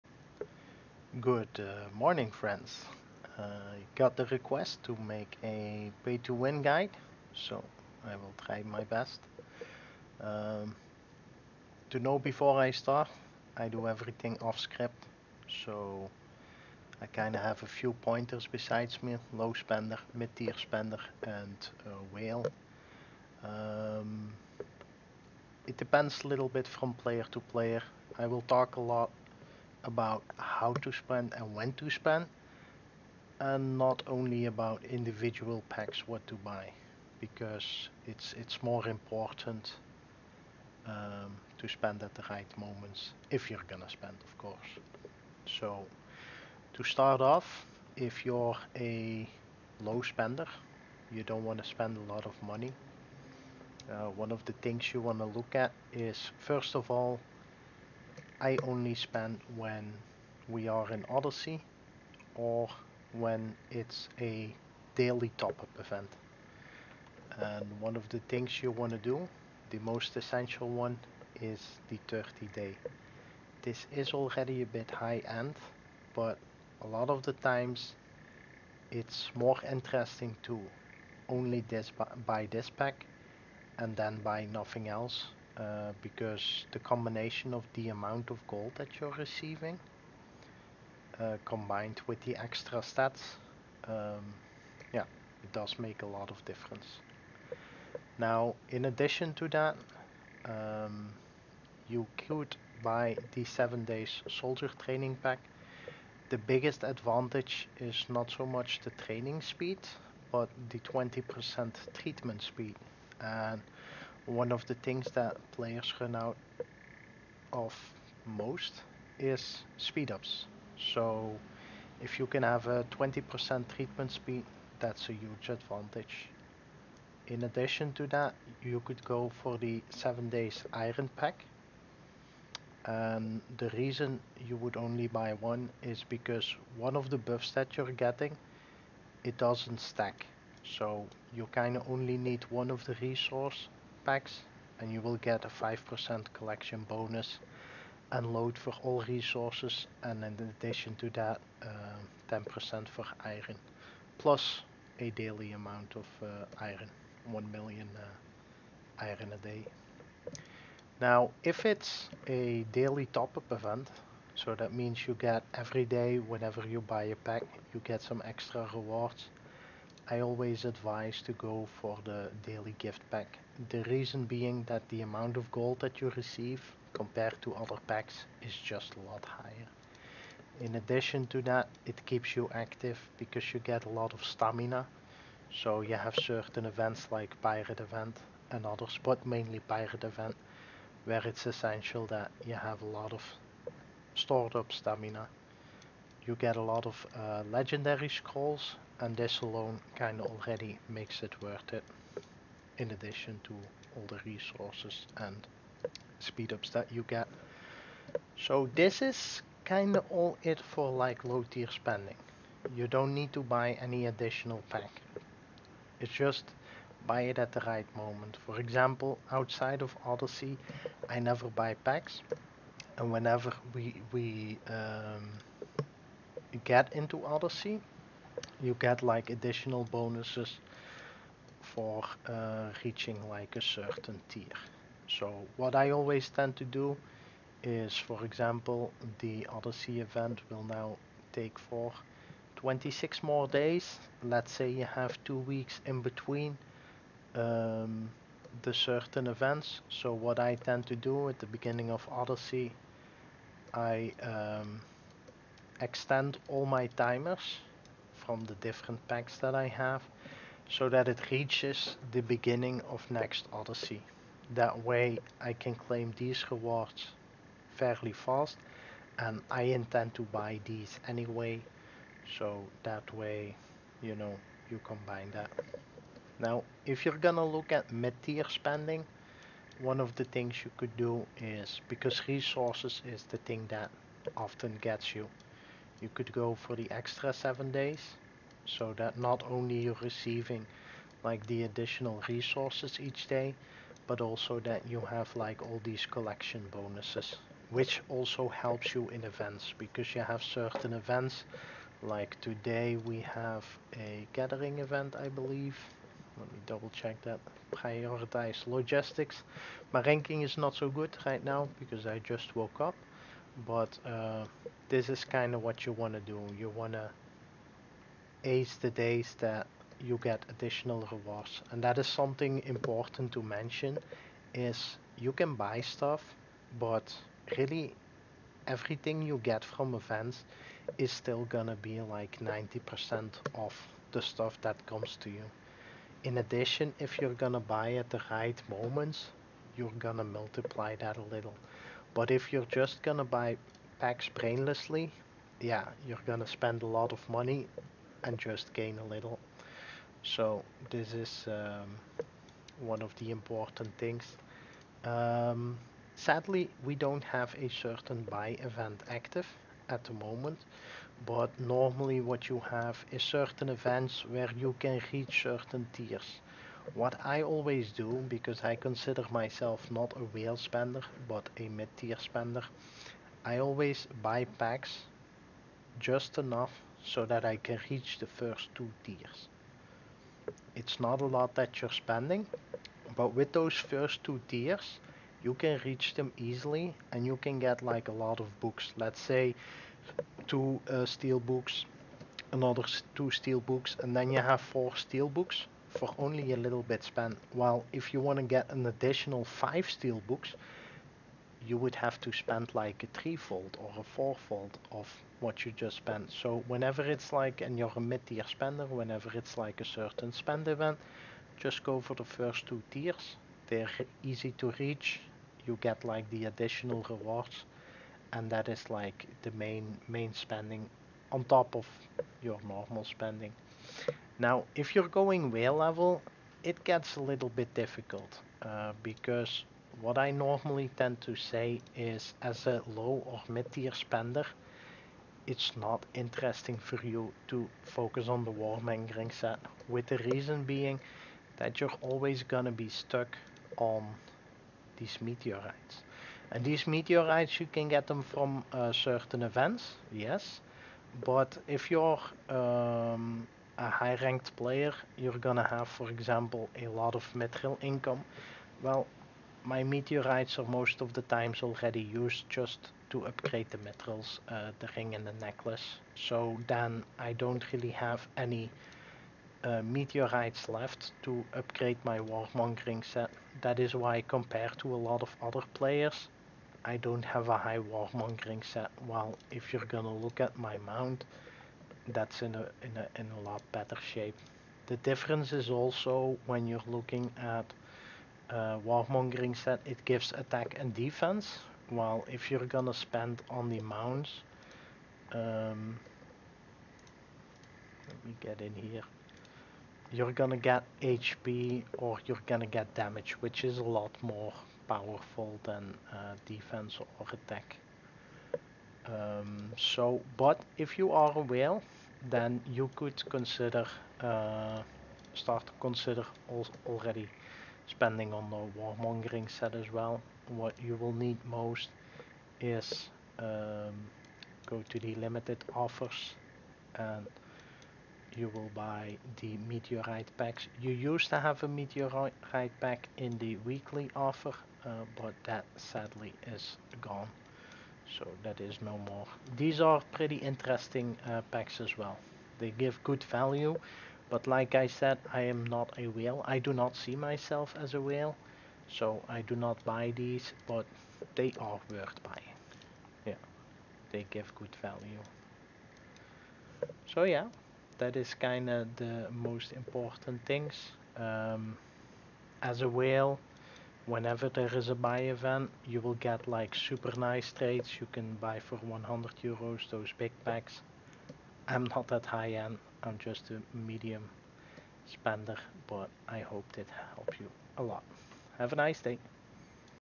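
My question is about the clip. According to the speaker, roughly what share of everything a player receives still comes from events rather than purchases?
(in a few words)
90%.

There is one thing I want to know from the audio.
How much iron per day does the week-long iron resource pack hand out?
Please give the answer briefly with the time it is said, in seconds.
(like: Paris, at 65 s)
1 million, at 157 s.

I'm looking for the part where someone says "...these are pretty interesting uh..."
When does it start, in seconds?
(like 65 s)
539 s.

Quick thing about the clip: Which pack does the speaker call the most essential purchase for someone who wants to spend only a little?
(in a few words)
The 30 day pack.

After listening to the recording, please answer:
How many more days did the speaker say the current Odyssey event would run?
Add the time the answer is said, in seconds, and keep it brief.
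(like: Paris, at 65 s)
26, at 242 s.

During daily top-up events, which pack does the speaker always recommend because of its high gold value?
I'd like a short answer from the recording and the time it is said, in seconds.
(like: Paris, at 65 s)
The daily gift pack, at 172 s.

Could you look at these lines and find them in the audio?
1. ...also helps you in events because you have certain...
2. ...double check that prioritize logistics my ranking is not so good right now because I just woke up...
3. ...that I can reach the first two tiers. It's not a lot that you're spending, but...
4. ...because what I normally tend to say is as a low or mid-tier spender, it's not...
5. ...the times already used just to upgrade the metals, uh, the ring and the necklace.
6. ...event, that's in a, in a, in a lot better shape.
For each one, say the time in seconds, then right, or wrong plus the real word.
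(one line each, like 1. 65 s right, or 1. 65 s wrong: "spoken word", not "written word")
1. 298 s right
2. 306 s right
3. 377 s right
4. 429 s right
5. 461 s right
6. 480 s wrong: "mount", not "event".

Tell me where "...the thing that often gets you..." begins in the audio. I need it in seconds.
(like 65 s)
283 s.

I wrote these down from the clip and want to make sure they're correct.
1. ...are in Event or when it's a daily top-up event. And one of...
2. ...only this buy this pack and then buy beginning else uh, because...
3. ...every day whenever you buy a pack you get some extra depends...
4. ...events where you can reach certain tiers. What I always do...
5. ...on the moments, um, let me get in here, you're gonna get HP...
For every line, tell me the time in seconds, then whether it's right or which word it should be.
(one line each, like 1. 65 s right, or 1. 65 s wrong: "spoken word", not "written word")
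1. 60 s wrong: "Odyssey", not "Event"
2. 81 s wrong: "nothing", not "beginning"
3. 165 s wrong: "rewards", not "depends"
4. 363 s right
5. 493 s wrong: "mounts", not "moments".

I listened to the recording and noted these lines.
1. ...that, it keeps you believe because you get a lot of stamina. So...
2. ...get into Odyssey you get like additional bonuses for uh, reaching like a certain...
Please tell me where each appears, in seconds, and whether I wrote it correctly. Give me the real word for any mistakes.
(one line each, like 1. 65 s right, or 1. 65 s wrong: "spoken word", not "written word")
1. 181 s wrong: "active", not "believe"
2. 226 s right.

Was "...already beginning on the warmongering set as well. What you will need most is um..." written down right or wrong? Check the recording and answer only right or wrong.
wrong.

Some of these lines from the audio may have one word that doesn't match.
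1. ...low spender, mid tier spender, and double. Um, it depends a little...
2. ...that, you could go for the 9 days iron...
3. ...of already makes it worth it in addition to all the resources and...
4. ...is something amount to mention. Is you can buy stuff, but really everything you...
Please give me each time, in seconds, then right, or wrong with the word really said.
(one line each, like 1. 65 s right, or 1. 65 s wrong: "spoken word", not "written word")
1. 19 s wrong: "whale", not "double"
2. 128 s wrong: "7", not "9"
3. 200 s right
4. 321 s wrong: "important", not "amount".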